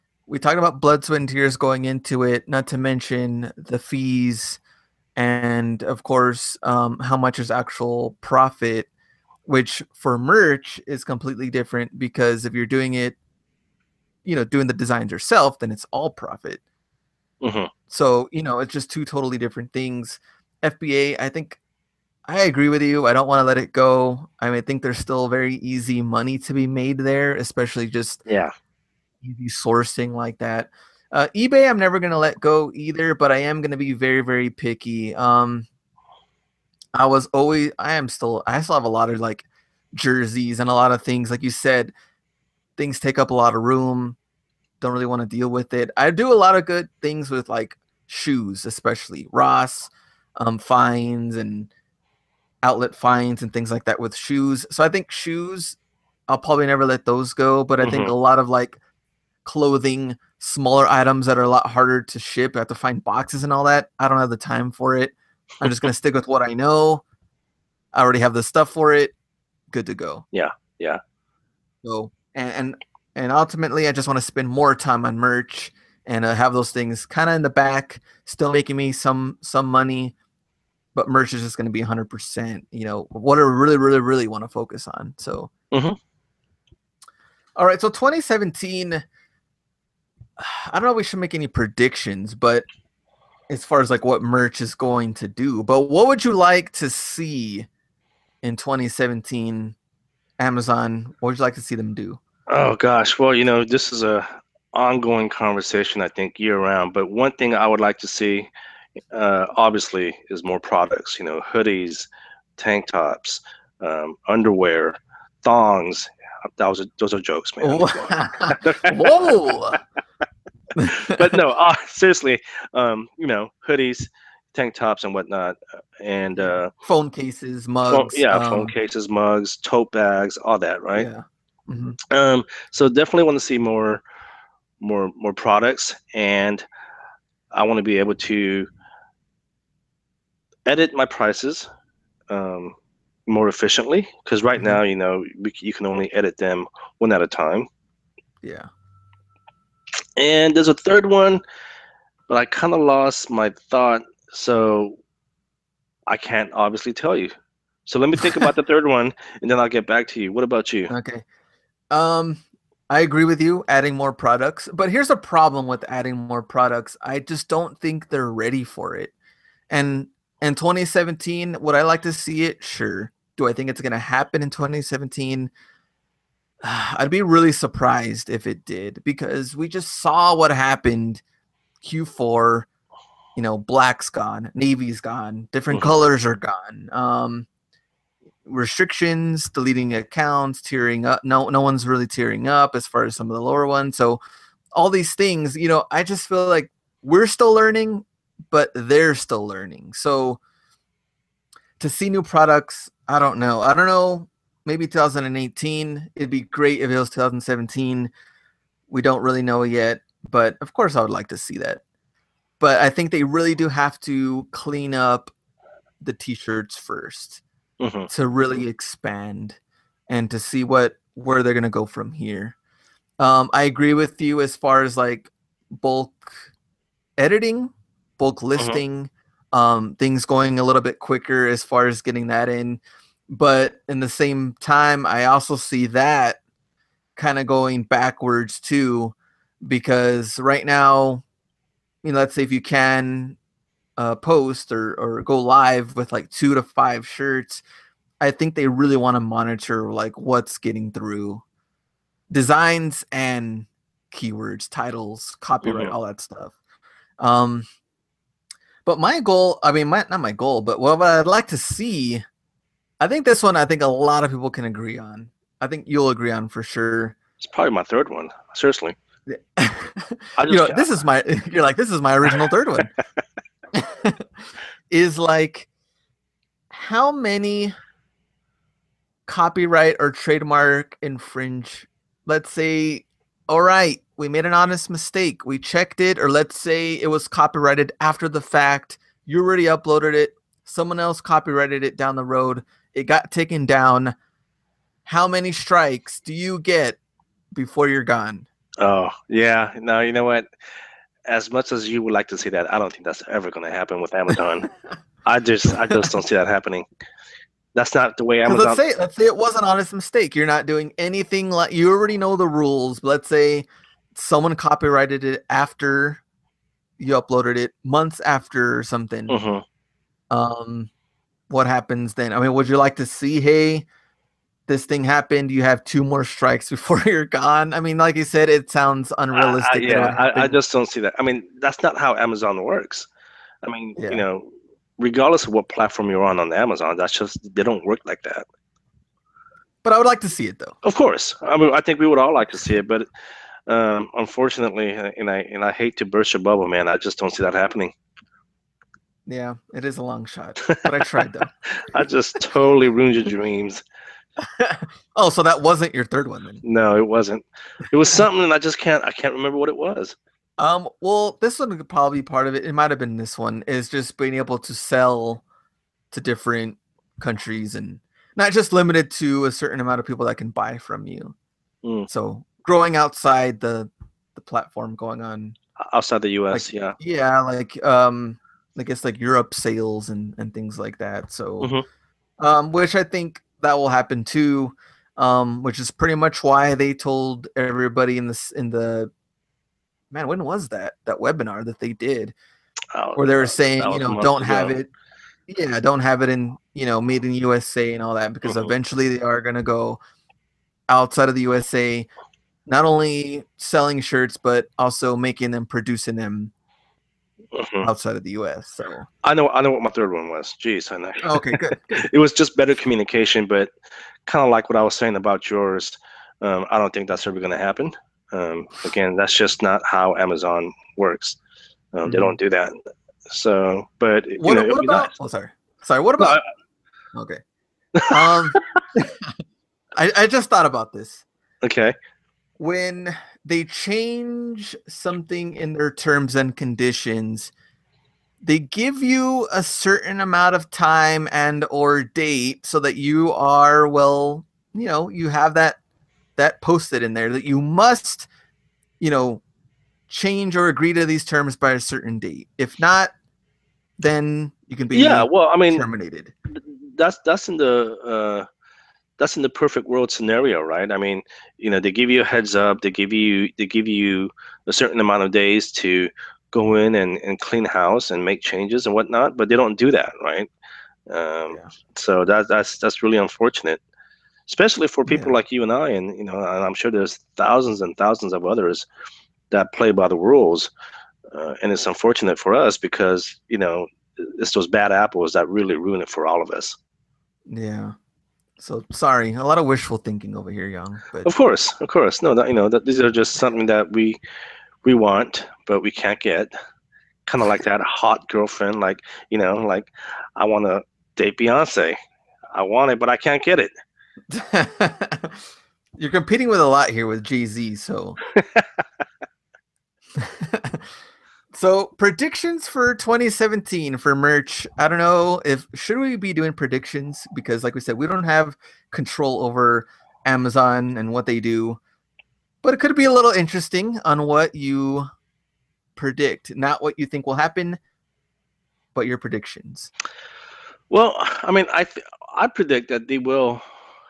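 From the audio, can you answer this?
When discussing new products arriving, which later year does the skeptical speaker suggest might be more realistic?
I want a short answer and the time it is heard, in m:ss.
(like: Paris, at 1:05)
2018, at 3:24.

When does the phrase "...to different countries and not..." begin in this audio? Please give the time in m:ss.
6:06.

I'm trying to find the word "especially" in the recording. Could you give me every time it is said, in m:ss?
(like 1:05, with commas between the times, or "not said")
0:27, 0:48, 7:54.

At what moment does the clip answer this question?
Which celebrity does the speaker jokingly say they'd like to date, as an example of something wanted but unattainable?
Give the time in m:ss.
8:21.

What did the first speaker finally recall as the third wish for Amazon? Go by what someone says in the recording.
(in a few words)
better communication.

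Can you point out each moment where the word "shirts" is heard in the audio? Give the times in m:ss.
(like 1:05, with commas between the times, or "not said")
3:36, 4:07, 6:43.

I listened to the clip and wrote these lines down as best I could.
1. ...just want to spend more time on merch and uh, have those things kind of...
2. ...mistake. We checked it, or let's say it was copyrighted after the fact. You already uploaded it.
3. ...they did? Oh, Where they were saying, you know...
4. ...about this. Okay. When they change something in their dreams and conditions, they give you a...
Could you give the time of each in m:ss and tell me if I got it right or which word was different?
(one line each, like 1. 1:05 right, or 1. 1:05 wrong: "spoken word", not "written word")
1. 1:13 right
2. 4:44 right
3. 6:31 right
4. 7:10 wrong: "terms", not "dreams".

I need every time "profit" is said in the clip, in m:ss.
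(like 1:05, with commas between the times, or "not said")
0:08, 0:16.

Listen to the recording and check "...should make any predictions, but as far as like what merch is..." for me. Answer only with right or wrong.
right.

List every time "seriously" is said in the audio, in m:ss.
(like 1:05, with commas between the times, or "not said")
2:01, 4:28.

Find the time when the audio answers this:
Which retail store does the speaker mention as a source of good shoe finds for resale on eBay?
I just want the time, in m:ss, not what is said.
0:49.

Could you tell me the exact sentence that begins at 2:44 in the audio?
But here's a problem with adding more products.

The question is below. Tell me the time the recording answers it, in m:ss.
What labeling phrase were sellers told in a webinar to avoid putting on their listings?
6:37.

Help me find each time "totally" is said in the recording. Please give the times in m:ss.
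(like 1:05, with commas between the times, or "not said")
0:19, 5:52.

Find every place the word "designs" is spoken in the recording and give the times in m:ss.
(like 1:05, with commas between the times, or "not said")
0:14, 4:12.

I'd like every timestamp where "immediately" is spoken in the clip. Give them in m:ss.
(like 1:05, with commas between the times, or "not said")
not said.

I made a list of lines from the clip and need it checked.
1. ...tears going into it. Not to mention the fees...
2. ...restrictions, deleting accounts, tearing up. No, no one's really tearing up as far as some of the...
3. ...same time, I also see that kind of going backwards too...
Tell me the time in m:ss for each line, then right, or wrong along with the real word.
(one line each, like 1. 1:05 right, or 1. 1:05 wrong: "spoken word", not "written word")
1. 0:01 right
2. 3:08 right
3. 3:54 right.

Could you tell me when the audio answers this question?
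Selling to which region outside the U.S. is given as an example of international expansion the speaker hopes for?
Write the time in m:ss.
6:19.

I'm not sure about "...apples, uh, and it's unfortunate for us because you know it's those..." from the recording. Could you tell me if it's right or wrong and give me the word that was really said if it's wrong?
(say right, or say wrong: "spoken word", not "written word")
wrong: "rules", not "apples".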